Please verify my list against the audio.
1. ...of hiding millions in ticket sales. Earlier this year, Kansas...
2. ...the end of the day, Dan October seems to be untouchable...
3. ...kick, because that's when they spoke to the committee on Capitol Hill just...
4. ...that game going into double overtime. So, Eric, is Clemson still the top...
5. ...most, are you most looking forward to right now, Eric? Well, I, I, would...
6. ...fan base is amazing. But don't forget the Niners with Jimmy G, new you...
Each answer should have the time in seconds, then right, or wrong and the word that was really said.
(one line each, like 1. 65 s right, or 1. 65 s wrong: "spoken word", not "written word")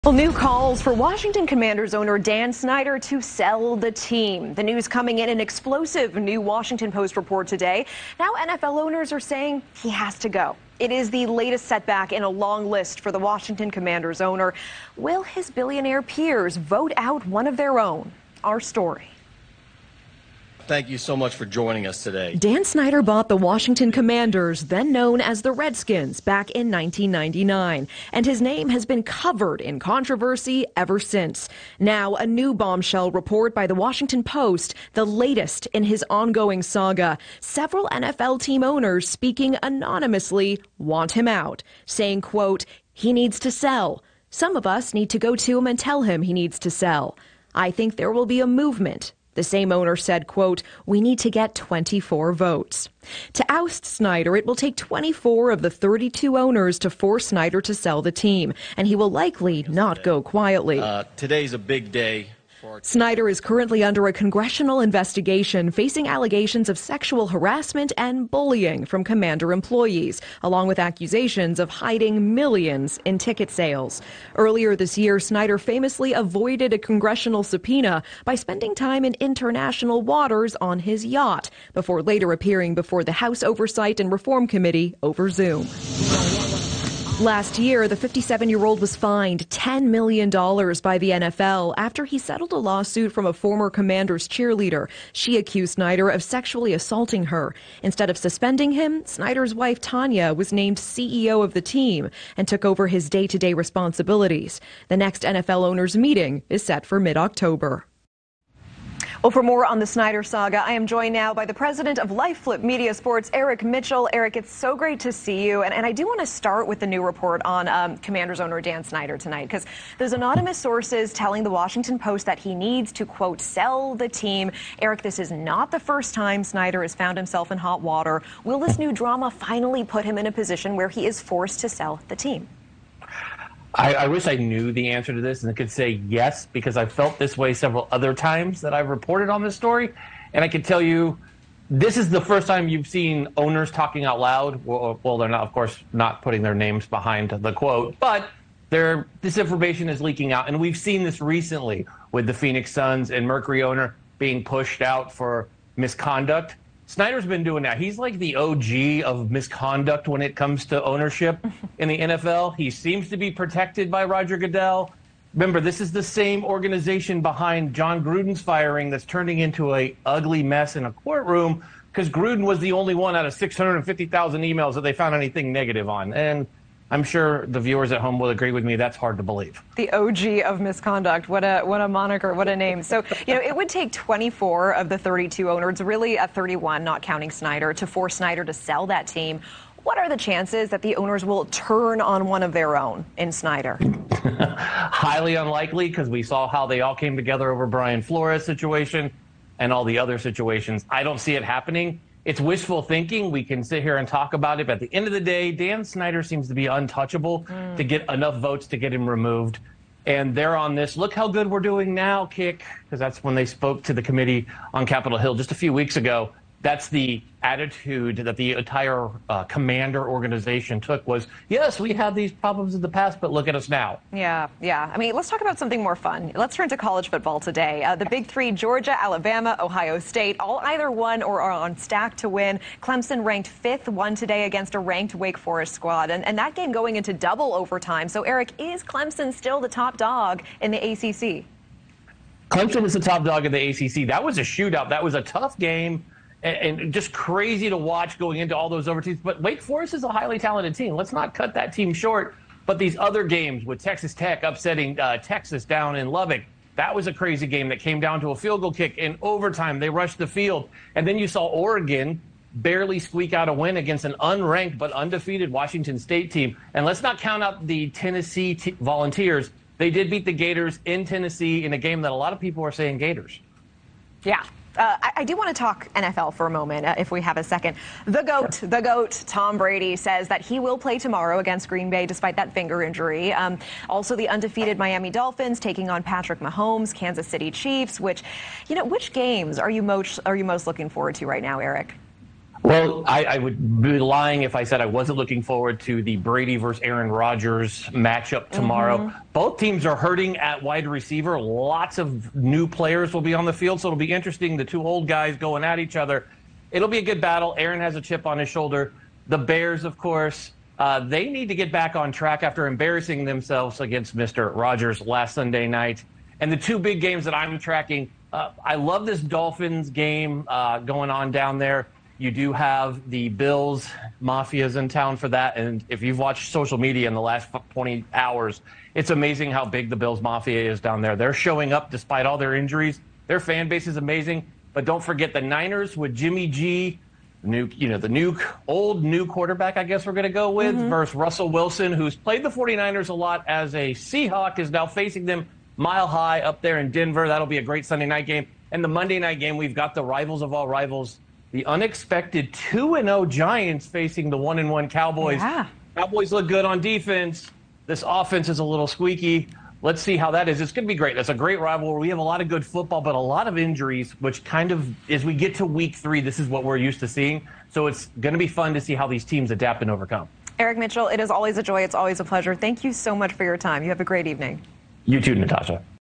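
1. 71 s wrong: "Snyder", not "Kansas"
2. 204 s wrong: "Snyder", not "October"
3. 212 s right
4. 236 s right
5. 289 s right
6. 333 s right.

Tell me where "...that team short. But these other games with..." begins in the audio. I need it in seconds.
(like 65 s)
251 s.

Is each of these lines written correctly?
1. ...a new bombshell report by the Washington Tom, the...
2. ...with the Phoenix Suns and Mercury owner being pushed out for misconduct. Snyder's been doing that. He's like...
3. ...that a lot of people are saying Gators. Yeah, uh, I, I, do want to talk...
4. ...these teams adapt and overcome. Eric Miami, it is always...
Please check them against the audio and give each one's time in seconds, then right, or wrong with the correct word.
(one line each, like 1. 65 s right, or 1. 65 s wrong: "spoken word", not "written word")
1. 32 s wrong: "Post", not "Tom"
2. 152 s right
3. 272 s right
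4. 369 s wrong: "Mitchell", not "Miami".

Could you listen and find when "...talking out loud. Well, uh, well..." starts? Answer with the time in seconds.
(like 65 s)
143 s.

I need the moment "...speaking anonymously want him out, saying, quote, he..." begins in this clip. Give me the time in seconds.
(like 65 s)
39 s.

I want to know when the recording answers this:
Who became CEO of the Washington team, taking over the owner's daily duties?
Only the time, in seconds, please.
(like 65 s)
99 s.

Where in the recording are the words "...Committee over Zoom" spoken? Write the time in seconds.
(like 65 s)
84 s.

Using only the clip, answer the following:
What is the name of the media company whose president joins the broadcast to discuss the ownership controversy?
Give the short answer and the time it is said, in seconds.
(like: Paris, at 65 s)
LifeFlip Media Sports, at 112 s.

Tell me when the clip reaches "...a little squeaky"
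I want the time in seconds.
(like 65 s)
358 s.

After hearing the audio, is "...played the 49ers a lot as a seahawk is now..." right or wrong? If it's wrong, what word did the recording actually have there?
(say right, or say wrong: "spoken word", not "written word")
right.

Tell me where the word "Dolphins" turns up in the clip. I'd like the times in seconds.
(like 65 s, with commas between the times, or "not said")
285 s, 319 s.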